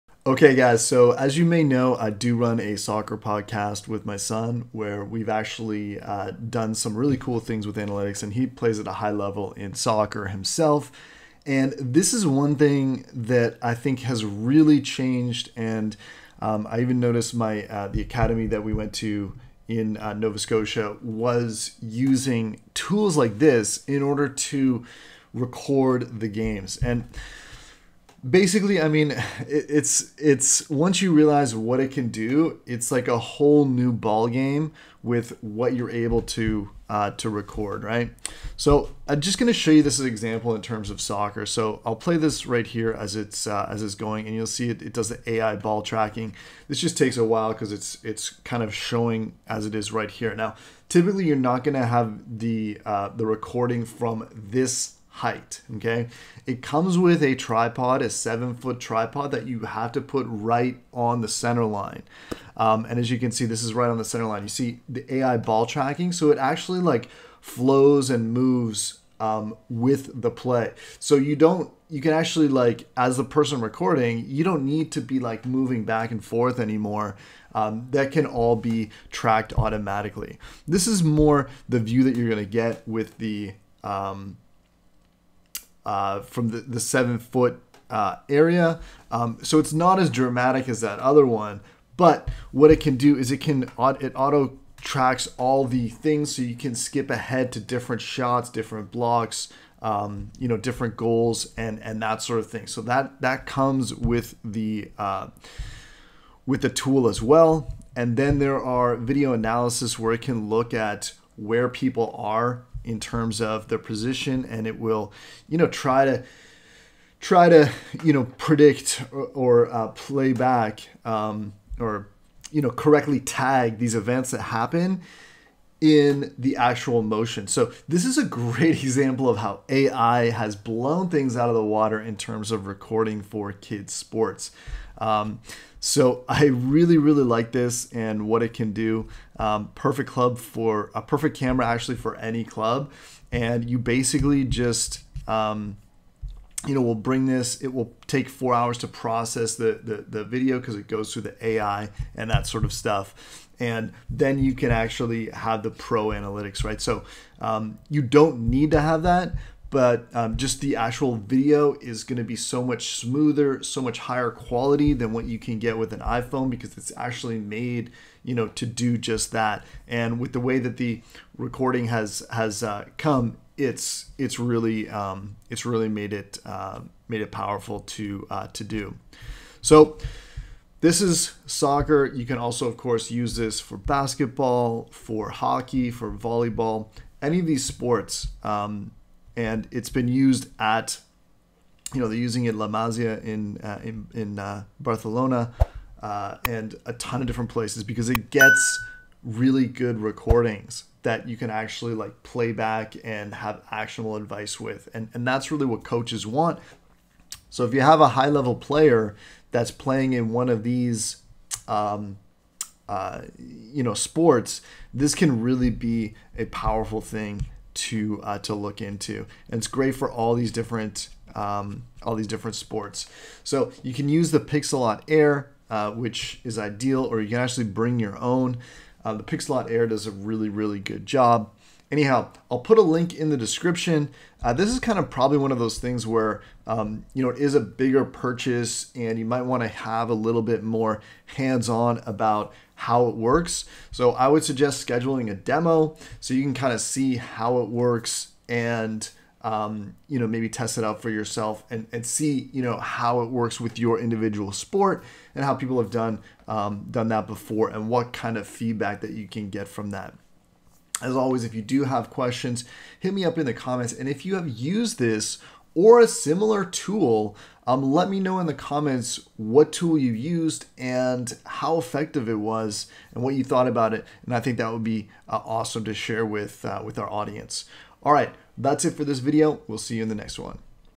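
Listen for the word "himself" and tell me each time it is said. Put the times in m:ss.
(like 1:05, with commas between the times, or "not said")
0:10.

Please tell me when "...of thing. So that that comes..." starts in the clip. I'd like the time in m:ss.
1:42.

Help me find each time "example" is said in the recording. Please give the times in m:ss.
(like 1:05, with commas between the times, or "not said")
0:40, 2:08.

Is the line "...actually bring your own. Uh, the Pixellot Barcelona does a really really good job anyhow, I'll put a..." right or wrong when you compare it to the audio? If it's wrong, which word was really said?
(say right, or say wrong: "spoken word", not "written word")
wrong: "Air", not "Barcelona".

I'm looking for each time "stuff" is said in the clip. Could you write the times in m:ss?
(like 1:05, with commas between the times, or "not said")
2:32.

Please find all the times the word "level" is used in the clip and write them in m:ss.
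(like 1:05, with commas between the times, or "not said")
0:09, 3:28.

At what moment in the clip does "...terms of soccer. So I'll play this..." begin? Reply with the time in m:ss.
0:40.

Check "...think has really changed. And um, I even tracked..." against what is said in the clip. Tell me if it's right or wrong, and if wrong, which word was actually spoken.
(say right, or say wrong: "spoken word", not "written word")
wrong: "noticed", not "tracked".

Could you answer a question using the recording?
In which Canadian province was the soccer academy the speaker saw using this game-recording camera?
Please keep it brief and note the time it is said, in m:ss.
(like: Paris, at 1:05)
Nova Scotia, at 0:20.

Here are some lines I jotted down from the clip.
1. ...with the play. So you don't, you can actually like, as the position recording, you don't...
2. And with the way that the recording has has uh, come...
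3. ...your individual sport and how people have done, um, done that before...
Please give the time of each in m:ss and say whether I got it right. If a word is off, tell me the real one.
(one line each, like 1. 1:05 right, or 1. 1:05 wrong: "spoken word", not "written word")
1. 1:09 wrong: "person", not "position"
2. 2:49 right
3. 4:13 right.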